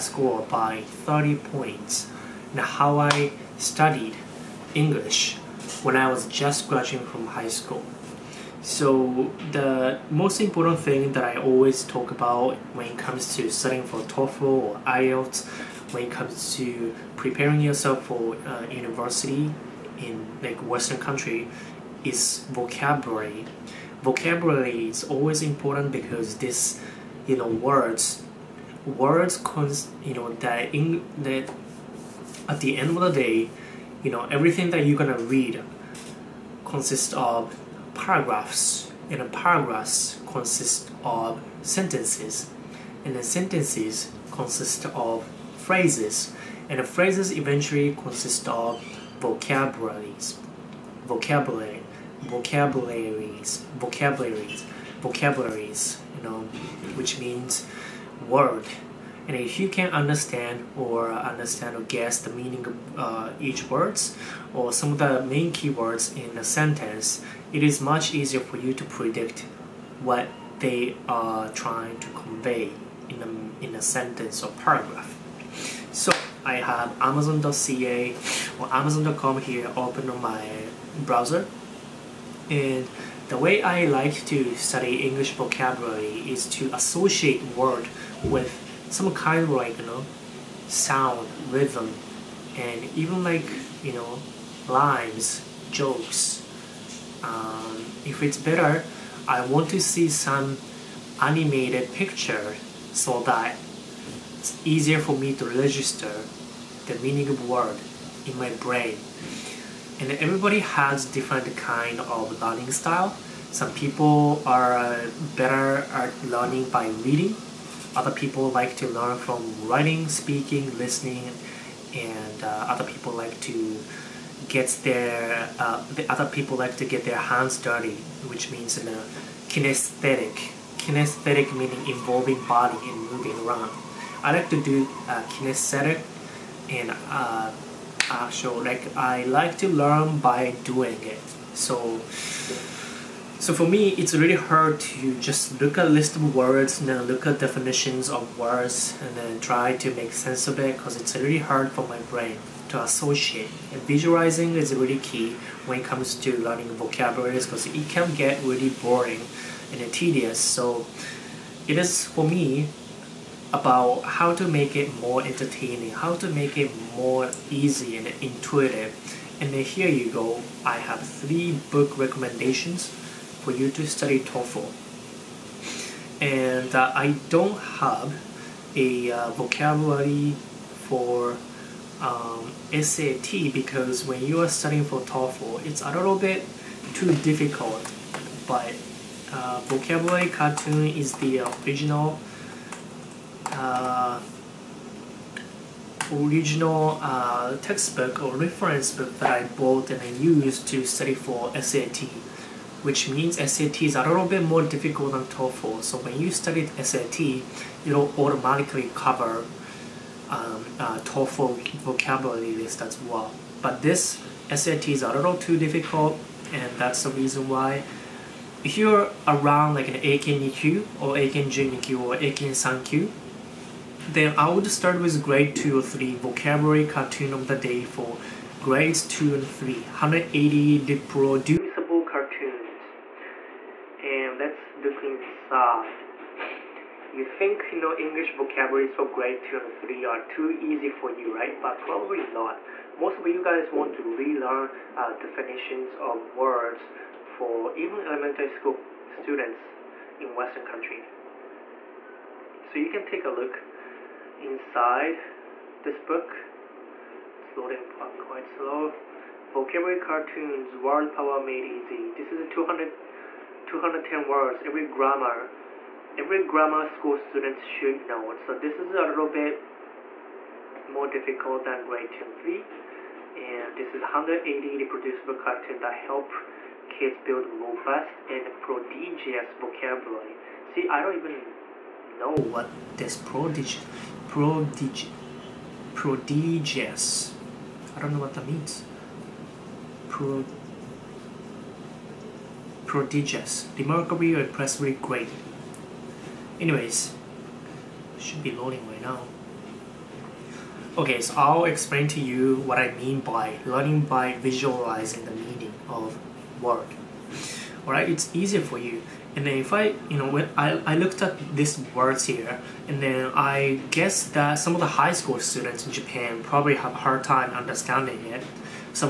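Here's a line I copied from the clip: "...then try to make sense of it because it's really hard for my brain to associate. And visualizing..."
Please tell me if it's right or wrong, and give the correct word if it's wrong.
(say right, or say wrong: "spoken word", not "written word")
right.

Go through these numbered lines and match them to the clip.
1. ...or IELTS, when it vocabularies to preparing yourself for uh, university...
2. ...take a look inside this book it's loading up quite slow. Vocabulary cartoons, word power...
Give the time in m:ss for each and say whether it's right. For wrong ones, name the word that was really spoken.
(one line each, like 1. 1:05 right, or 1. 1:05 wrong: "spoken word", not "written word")
1. 0:14 wrong: "comes", not "vocabularies"
2. 4:13 right.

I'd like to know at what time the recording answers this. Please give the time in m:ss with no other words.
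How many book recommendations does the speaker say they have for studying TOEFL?
2:51.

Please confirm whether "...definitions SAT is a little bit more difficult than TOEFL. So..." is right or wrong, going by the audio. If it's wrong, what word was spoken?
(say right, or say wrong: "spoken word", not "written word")
wrong: "means", not "definitions".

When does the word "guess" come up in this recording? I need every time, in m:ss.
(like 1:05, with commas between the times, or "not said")
1:01, 5:13.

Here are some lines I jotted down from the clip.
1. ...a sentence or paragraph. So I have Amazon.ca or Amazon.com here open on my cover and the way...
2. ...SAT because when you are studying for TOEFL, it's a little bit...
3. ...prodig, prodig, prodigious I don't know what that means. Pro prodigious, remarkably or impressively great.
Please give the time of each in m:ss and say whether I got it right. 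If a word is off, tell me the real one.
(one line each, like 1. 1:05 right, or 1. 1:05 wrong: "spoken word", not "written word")
1. 1:13 wrong: "browser", not "cover"
2. 3:02 right
3. 4:43 right.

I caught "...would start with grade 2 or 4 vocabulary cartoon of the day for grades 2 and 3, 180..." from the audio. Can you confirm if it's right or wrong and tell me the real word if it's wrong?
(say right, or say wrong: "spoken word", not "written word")
wrong: "3", not "4".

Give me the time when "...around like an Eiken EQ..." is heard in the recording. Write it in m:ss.
3:39.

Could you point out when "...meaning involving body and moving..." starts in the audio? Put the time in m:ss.
2:11.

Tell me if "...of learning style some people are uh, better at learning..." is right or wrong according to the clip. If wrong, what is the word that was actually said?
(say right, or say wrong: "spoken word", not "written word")
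right.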